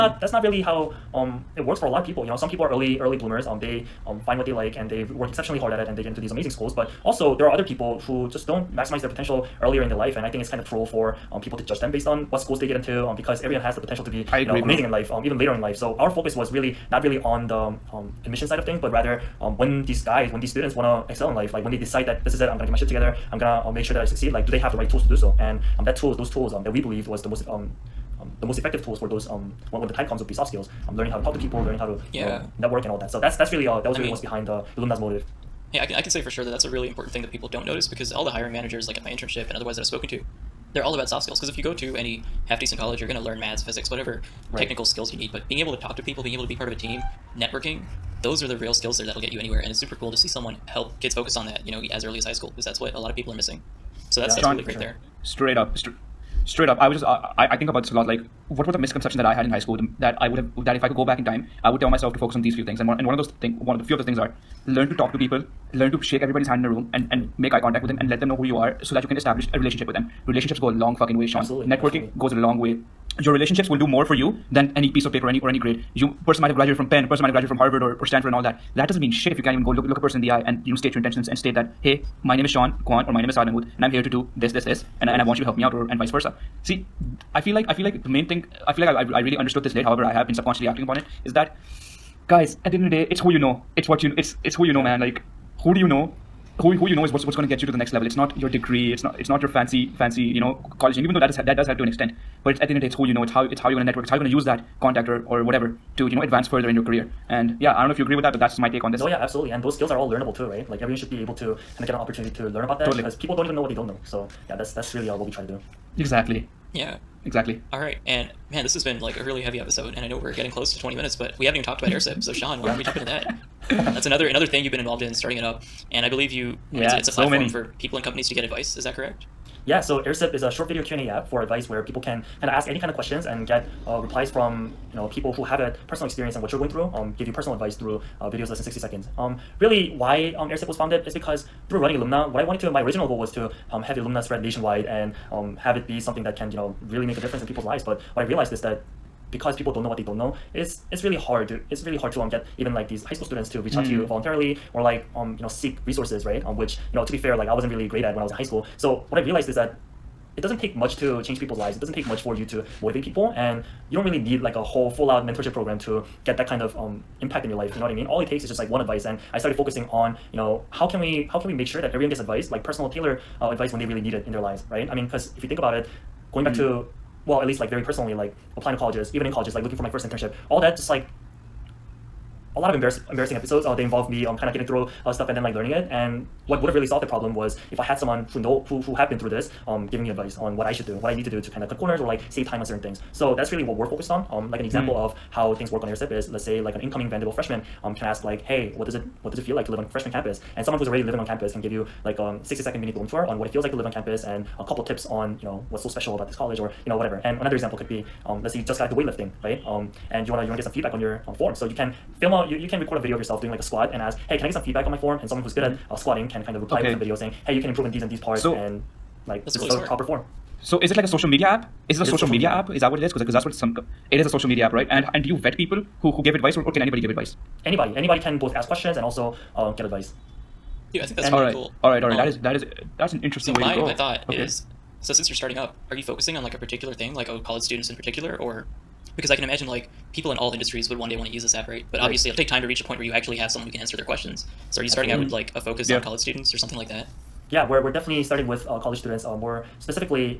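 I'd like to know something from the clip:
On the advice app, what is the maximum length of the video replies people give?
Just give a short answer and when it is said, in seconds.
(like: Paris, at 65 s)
60 seconds, at 138 s.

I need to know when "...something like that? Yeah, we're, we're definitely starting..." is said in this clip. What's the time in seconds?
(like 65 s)
246 s.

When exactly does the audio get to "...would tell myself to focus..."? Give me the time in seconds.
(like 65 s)
61 s.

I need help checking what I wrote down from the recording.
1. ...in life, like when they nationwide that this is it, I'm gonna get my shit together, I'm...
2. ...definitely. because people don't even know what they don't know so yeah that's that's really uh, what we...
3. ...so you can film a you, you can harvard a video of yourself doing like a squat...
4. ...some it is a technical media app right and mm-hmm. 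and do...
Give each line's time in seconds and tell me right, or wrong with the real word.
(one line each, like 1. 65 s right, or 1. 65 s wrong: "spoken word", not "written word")
1. 21 s wrong: "decide", not "nationwide"
2. 112 s wrong: "totally", not "definitely"
3. 211 s wrong: "record", not "harvard"
4. 223 s wrong: "social", not "technical".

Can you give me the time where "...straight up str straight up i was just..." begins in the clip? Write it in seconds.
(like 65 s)
55 s.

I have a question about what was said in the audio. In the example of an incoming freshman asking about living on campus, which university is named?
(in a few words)
Vanderbilt.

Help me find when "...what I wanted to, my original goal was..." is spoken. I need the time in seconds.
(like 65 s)
142 s.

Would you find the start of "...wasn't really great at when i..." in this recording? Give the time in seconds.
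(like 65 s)
157 s.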